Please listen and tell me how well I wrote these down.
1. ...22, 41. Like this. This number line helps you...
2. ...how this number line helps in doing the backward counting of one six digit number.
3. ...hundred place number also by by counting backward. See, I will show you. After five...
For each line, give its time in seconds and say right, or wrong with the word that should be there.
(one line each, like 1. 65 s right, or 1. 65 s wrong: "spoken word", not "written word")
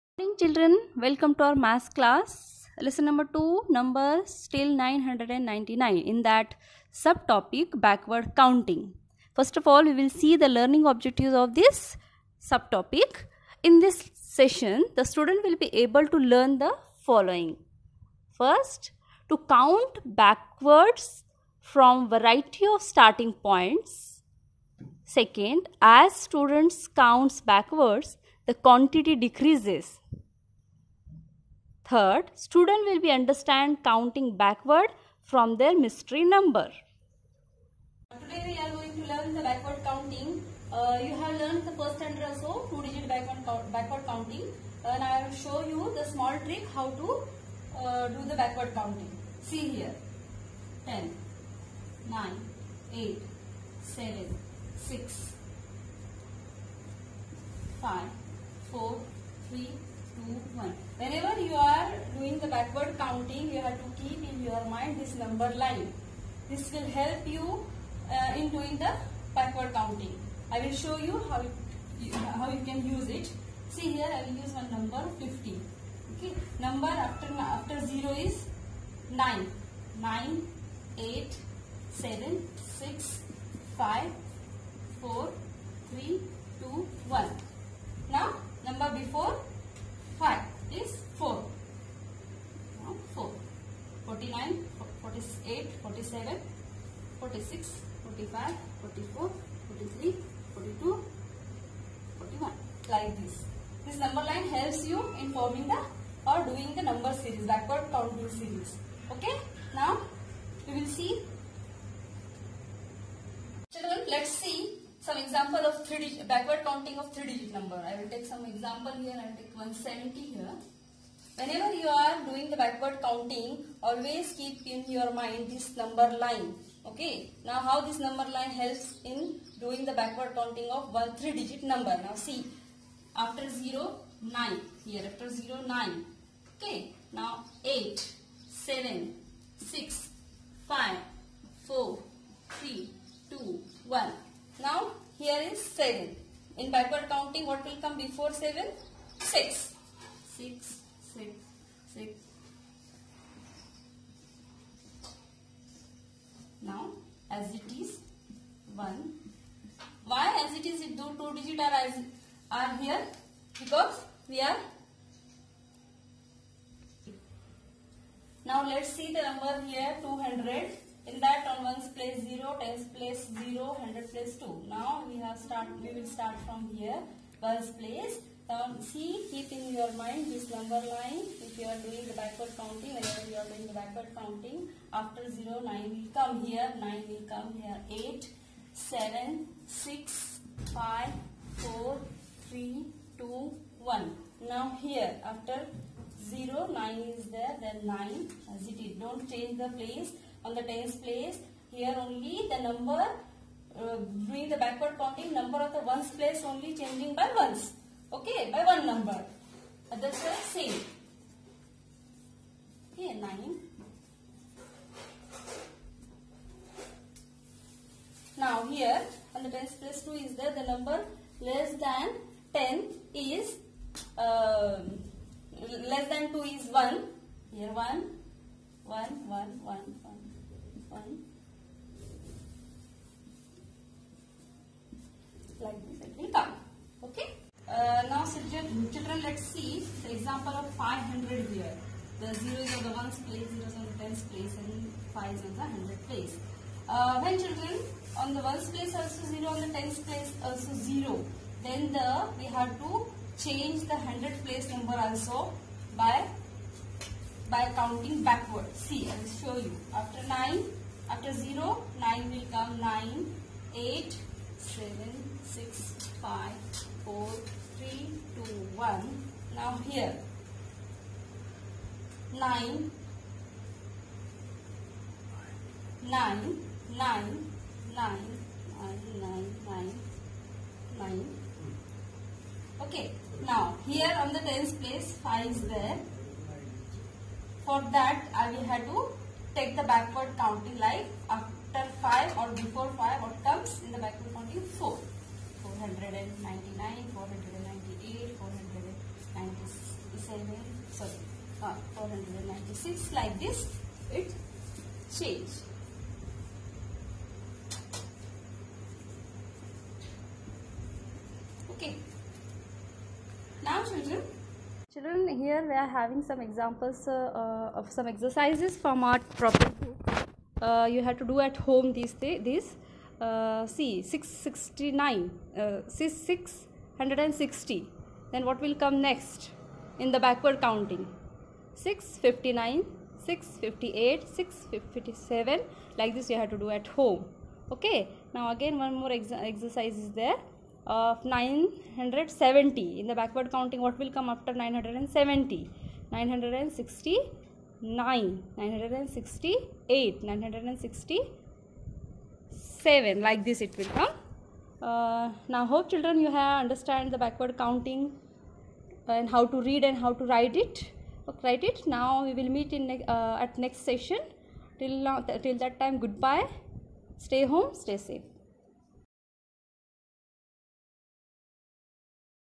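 1. 100 s wrong: "42", not "22"
2. 127 s wrong: "three", not "six"
3. 254 s wrong: "nine", not "five".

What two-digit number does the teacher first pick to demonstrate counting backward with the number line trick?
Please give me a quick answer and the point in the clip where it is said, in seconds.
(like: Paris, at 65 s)
50, at 75 s.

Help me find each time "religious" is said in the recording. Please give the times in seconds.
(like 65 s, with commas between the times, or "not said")
not said.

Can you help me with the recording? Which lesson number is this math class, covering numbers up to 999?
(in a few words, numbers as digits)
2.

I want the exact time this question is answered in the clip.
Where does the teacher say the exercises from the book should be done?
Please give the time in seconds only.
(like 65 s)
321 s.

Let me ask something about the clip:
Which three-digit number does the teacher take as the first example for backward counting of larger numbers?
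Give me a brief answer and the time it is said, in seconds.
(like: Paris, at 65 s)
170, at 119 s.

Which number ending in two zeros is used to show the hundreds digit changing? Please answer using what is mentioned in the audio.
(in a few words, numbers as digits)
500.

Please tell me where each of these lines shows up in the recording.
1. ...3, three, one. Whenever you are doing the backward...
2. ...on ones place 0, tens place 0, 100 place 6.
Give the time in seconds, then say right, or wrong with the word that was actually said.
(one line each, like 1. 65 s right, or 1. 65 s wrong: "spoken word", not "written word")
1. 59 s wrong: "two", not "three"
2. 171 s wrong: "2", not "6".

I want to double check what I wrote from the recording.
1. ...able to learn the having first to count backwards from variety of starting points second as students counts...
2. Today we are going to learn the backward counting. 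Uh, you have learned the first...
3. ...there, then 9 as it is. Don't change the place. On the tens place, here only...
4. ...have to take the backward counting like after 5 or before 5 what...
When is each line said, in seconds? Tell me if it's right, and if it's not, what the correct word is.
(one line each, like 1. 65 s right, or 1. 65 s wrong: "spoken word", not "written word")
1. 15 s wrong: "following", not "having"
2. 38 s right
3. 197 s right
4. 288 s right.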